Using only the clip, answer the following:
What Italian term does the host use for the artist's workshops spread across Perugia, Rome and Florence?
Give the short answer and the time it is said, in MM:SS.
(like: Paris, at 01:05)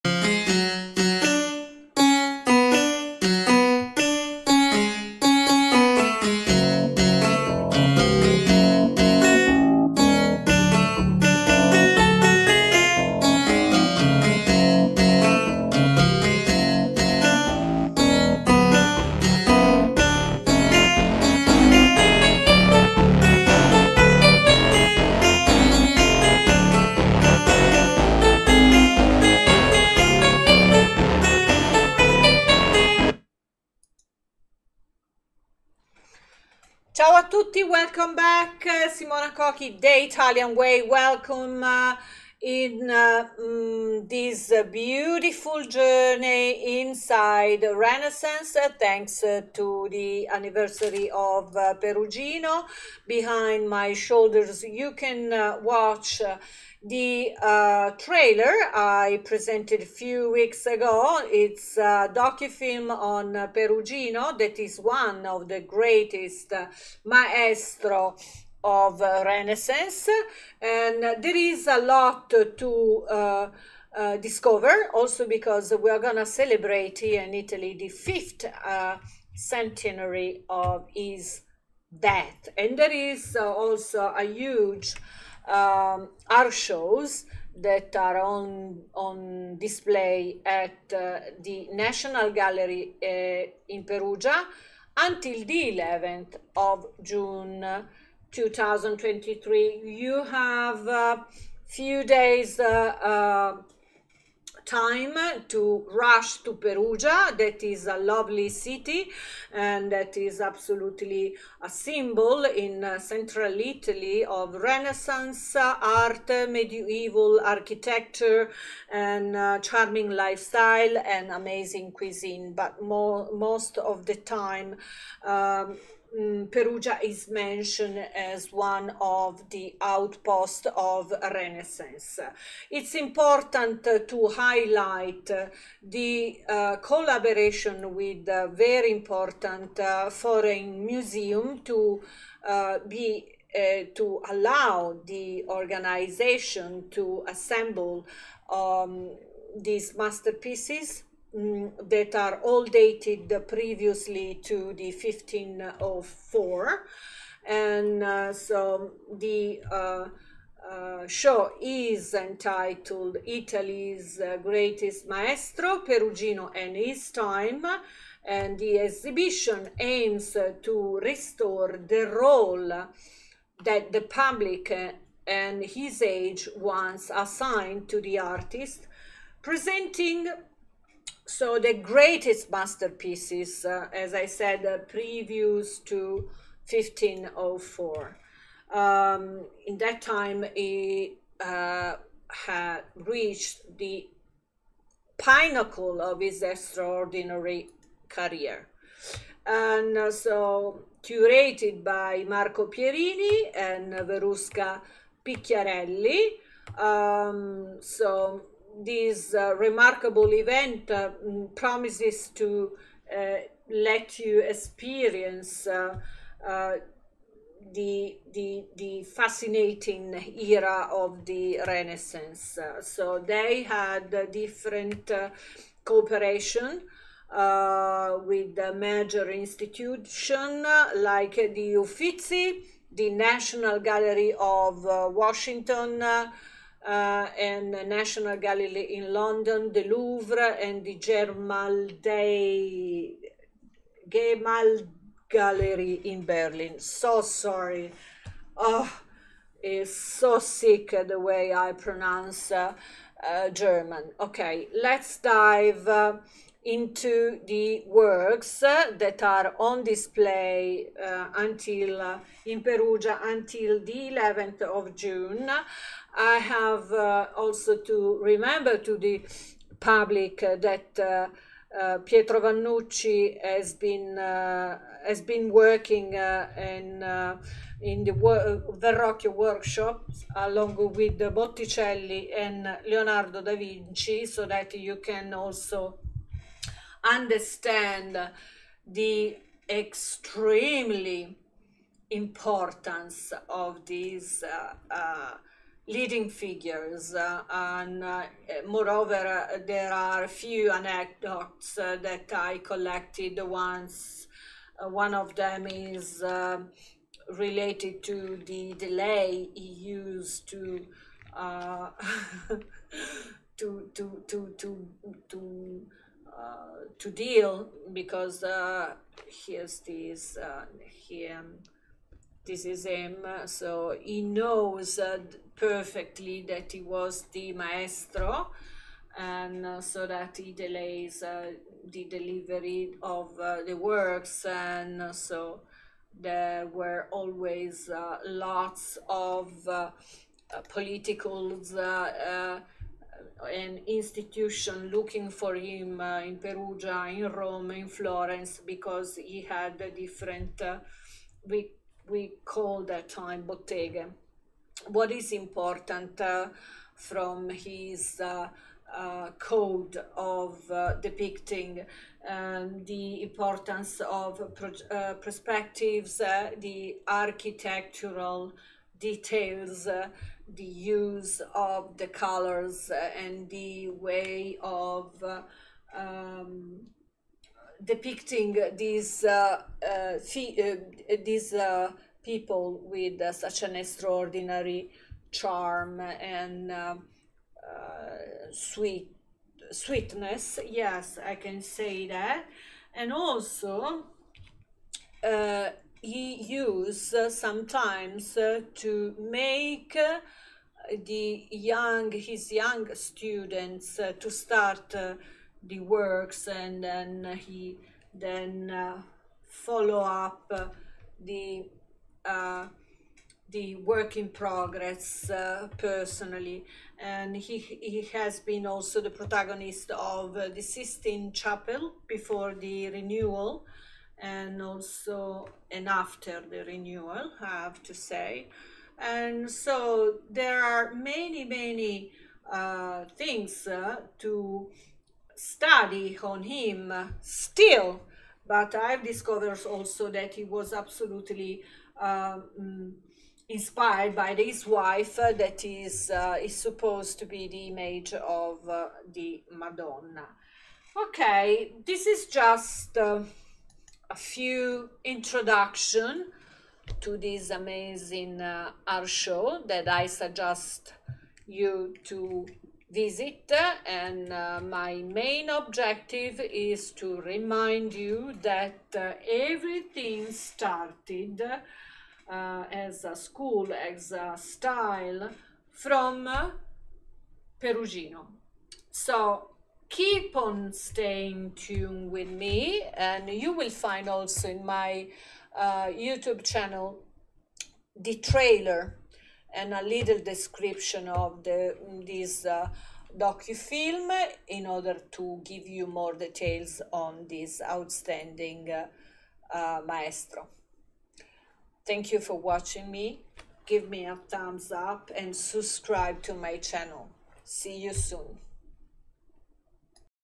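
Bottega, at 05:53.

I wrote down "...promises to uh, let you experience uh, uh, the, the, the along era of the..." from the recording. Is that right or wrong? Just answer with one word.
wrong.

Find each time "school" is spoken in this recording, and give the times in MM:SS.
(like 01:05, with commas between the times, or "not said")
07:53.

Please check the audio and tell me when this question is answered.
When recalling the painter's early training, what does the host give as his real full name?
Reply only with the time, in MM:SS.
04:32.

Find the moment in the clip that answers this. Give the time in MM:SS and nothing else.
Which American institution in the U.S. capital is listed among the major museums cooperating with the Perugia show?
03:53.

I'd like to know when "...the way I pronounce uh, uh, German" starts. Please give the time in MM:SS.
04:11.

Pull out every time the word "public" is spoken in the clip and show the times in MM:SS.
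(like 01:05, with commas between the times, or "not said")
02:54, 04:29.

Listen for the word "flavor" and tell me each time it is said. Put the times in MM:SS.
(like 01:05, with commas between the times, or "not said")
not said.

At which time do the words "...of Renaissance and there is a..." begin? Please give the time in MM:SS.
01:08.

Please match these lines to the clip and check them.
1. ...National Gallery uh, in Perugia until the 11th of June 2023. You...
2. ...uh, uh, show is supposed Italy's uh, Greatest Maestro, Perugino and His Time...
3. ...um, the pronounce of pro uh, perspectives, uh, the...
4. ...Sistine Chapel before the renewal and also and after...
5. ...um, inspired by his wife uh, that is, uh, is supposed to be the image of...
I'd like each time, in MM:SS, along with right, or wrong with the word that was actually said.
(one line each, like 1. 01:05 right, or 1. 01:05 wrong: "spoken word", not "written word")
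1. 01:31 right
2. 02:39 wrong: "entitled", not "supposed"
3. 06:02 wrong: "importance", not "pronounce"
4. 07:00 right
5. 07:21 right.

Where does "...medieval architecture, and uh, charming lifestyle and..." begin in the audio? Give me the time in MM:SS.
01:56.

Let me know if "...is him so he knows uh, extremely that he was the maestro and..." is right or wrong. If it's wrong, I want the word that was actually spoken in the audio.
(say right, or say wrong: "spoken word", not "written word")
wrong: "perfectly", not "extremely".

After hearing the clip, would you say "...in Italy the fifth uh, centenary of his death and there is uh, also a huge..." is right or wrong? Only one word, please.
right.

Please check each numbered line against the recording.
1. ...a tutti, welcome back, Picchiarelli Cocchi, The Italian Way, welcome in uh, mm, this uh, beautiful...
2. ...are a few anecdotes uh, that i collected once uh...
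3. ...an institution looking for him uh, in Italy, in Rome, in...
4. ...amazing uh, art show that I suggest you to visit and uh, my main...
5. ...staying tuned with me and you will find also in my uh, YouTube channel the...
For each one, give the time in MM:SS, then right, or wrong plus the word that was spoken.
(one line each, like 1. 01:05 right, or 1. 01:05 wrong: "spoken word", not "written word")
1. 00:37 wrong: "Simona", not "Picchiarelli"
2. 04:59 right
3. 05:43 wrong: "Perugia", not "Italy"
4. 07:37 right
5. 08:00 right.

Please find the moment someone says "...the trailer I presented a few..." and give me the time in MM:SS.
00:56.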